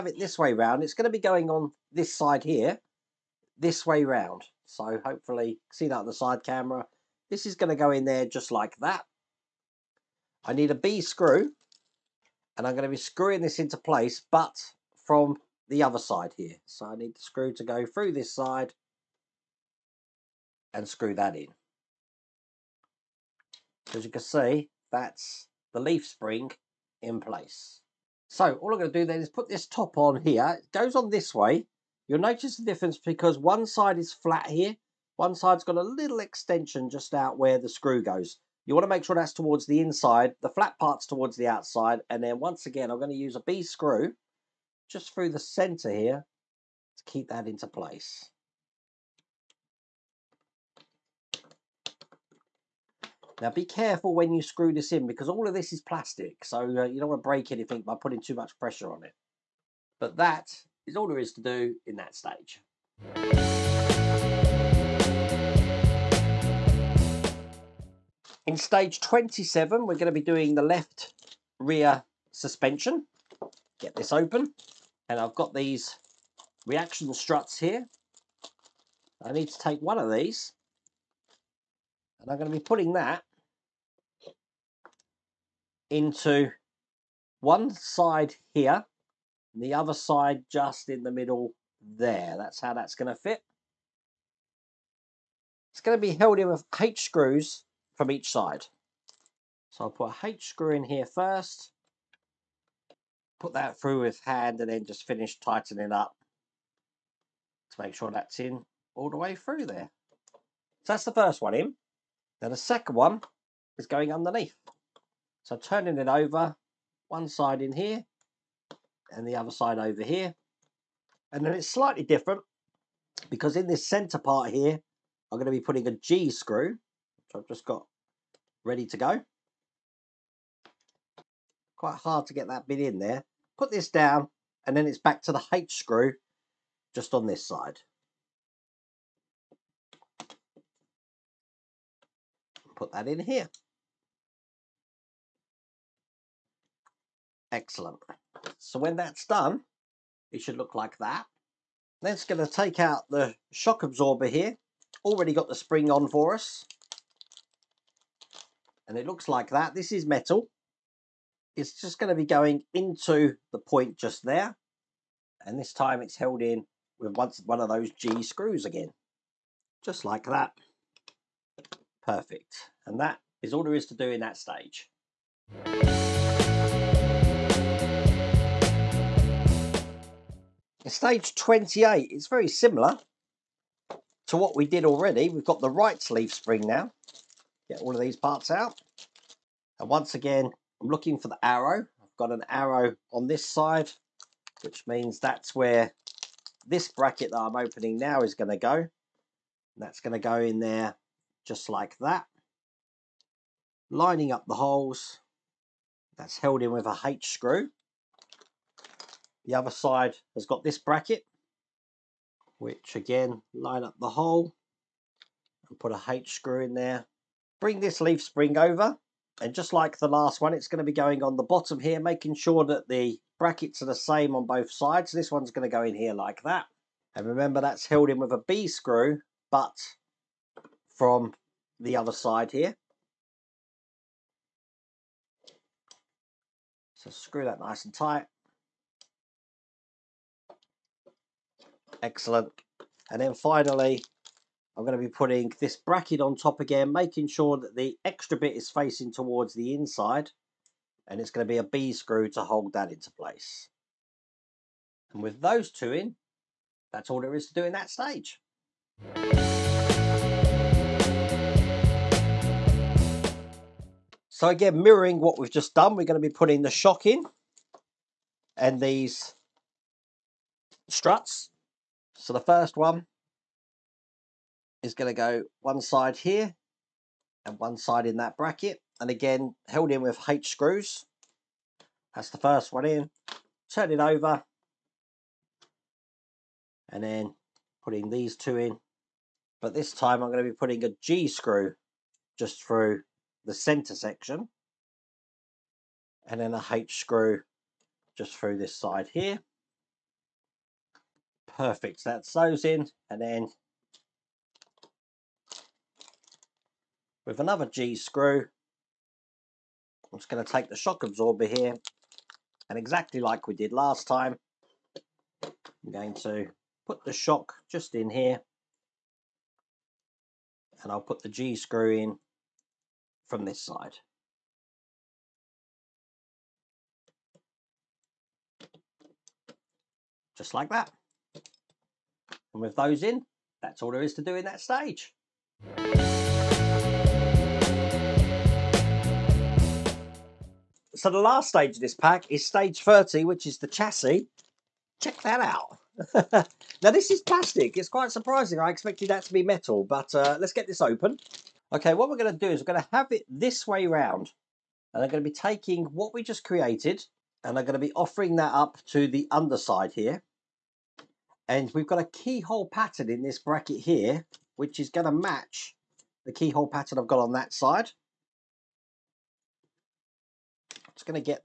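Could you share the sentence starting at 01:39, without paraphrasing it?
So I'll put a H screw in here first.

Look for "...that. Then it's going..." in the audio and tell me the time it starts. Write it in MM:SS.
02:30.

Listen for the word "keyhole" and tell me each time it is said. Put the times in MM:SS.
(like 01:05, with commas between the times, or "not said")
06:02, 06:06.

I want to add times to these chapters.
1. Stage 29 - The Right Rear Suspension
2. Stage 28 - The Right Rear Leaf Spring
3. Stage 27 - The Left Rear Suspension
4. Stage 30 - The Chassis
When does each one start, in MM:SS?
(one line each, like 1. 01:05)
1. 04:18
2. 02:54
3. 01:02
4. 05:34.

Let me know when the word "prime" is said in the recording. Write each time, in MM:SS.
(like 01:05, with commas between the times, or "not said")
not said.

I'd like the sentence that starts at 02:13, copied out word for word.
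Put this down and then it's back to the H screw just on this side.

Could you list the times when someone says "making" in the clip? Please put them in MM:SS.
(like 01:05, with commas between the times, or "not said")
03:41, 04:06.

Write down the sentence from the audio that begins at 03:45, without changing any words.
This one's going to go in here like that.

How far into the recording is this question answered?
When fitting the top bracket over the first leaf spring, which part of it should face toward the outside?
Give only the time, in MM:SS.
00:40.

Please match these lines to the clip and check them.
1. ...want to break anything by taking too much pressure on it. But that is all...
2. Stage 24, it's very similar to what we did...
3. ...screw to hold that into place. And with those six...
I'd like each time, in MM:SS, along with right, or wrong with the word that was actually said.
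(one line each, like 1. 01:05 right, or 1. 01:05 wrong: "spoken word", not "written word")
1. 00:57 wrong: "putting", not "taking"
2. 03:00 wrong: "28", not "24"
3. 04:11 wrong: "two", not "six".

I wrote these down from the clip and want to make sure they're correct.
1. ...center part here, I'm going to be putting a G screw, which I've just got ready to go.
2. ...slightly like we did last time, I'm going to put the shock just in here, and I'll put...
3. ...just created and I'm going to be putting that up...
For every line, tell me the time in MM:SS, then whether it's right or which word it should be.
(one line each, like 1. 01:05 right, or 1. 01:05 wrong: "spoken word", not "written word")
1. 02:03 right
2. 05:12 wrong: "exactly", not "slightly"
3. 05:56 wrong: "offering", not "putting".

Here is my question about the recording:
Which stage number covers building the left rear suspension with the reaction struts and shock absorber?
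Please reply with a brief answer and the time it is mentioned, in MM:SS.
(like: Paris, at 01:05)
27, at 01:08.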